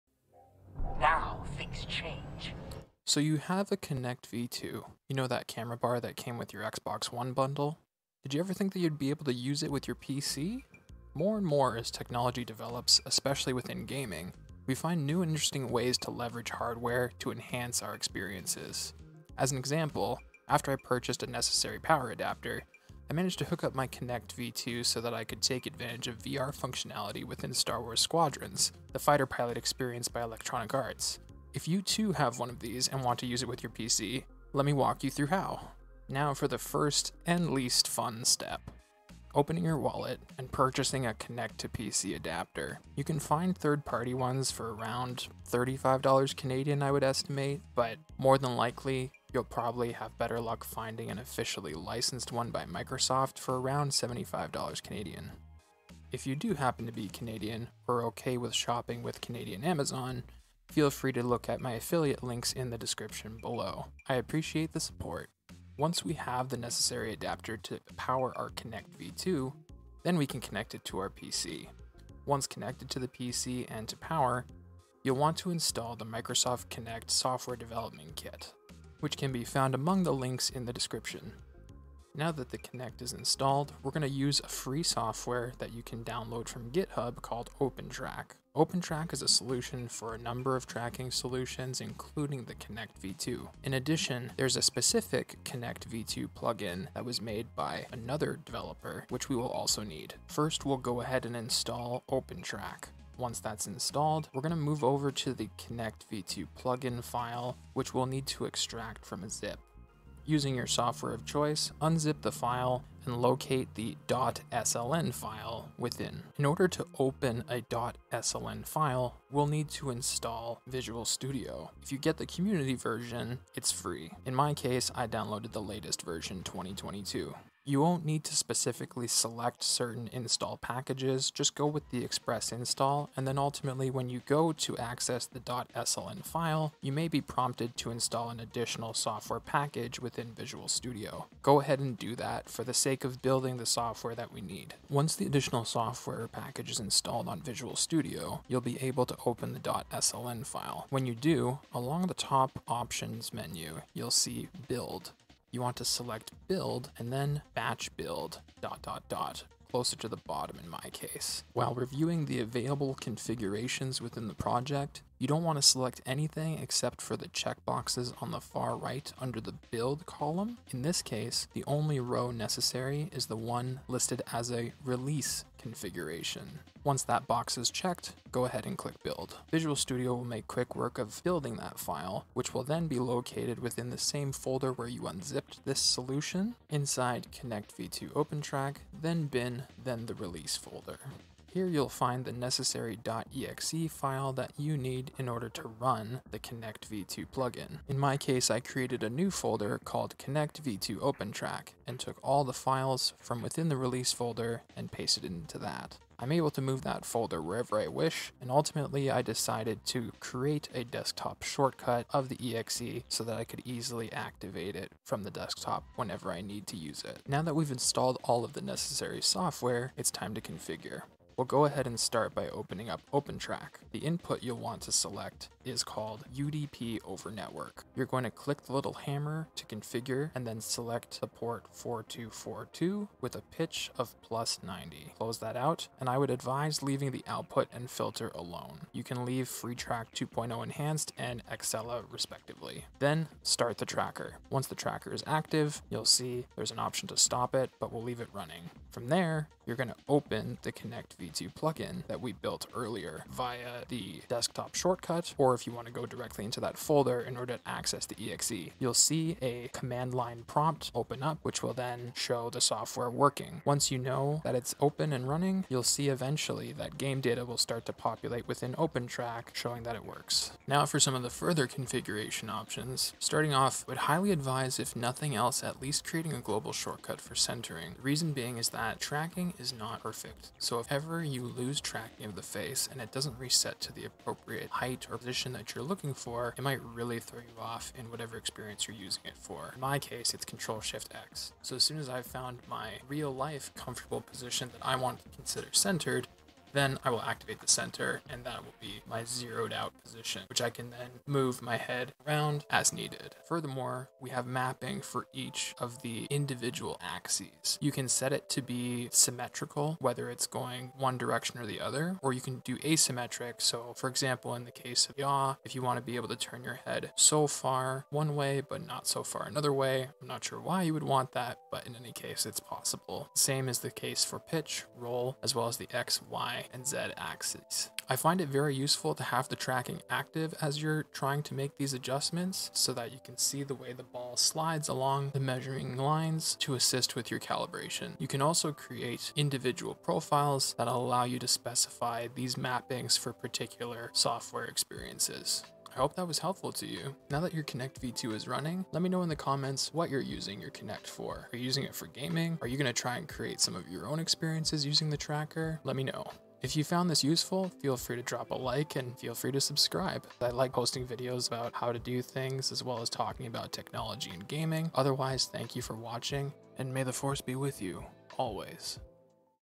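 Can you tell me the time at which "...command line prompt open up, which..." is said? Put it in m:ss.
4:19.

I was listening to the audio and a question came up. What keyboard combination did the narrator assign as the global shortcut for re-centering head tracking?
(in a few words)
Control Shift X.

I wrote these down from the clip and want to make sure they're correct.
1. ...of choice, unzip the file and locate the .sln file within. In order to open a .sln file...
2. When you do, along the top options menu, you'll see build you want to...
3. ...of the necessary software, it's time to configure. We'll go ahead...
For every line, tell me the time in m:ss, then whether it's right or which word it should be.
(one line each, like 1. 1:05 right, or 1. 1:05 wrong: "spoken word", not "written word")
1. 1:51 right
2. 2:30 right
3. 3:38 right.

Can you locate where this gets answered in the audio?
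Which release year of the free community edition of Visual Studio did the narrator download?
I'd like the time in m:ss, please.
2:06.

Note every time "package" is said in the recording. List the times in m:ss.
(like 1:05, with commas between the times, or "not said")
2:10, 2:19, 2:26.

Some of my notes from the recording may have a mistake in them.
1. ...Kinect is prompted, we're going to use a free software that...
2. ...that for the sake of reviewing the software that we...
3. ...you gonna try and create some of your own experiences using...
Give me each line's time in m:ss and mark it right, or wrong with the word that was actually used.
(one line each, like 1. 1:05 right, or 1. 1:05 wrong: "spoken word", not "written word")
1. 1:22 wrong: "installed", not "prompted"
2. 2:22 wrong: "building", not "reviewing"
3. 5:52 right.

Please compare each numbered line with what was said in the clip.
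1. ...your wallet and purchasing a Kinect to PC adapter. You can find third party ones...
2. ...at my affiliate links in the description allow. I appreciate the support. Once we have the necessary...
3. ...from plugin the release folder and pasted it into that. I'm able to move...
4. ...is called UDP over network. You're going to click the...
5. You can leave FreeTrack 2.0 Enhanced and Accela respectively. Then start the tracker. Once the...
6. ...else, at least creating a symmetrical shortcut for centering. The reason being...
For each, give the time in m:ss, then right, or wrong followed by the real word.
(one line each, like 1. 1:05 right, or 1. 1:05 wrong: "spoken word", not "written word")
1. 0:39 right
2. 1:01 wrong: "below", not "allow"
3. 3:23 wrong: "within", not "plugin"
4. 3:45 right
5. 3:58 right
6. 4:35 wrong: "global", not "symmetrical".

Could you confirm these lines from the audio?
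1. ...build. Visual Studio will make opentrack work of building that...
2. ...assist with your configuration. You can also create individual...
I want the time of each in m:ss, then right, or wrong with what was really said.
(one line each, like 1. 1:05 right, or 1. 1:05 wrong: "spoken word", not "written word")
1. 2:59 wrong: "quick", not "opentrack"
2. 5:36 wrong: "calibration", not "configuration".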